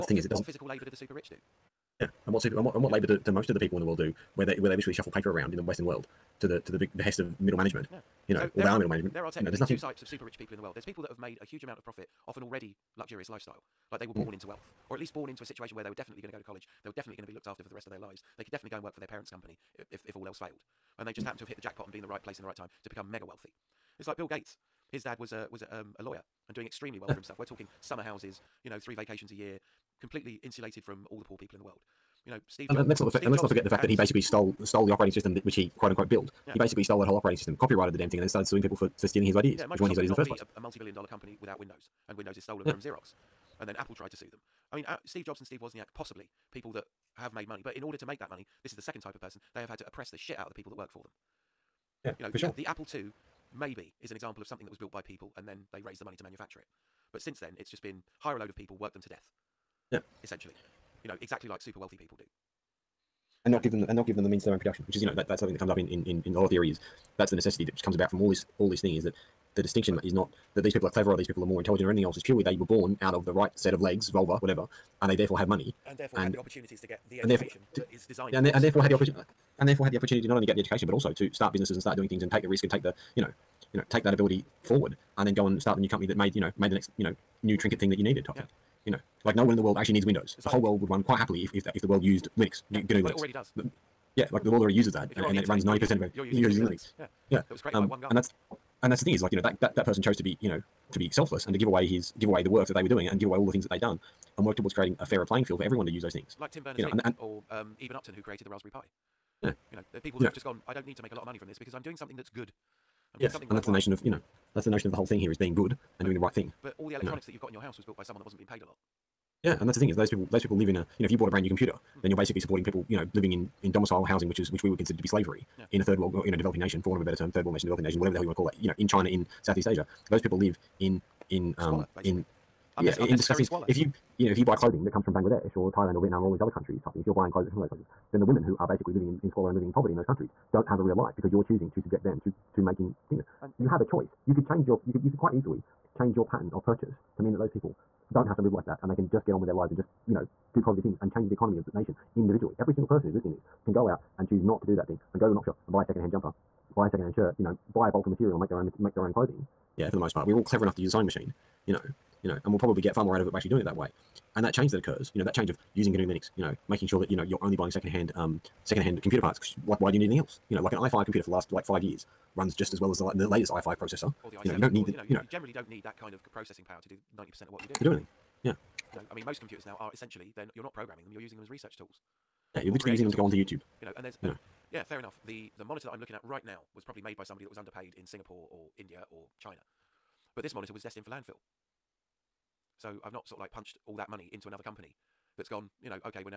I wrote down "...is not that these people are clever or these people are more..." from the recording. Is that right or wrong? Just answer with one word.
right.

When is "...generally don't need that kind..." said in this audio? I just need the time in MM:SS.
02:55.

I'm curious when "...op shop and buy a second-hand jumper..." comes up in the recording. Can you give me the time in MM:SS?
02:35.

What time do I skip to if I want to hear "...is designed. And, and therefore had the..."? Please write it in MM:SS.
01:17.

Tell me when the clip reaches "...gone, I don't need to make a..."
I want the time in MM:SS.
01:50.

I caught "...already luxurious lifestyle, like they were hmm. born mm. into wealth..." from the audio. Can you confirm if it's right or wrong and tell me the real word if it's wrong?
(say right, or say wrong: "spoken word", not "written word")
right.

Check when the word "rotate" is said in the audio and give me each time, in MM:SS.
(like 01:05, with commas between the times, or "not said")
not said.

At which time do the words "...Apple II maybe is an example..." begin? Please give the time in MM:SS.
00:52.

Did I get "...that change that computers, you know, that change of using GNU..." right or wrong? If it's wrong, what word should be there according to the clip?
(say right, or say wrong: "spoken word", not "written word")
wrong: "occurs", not "computers".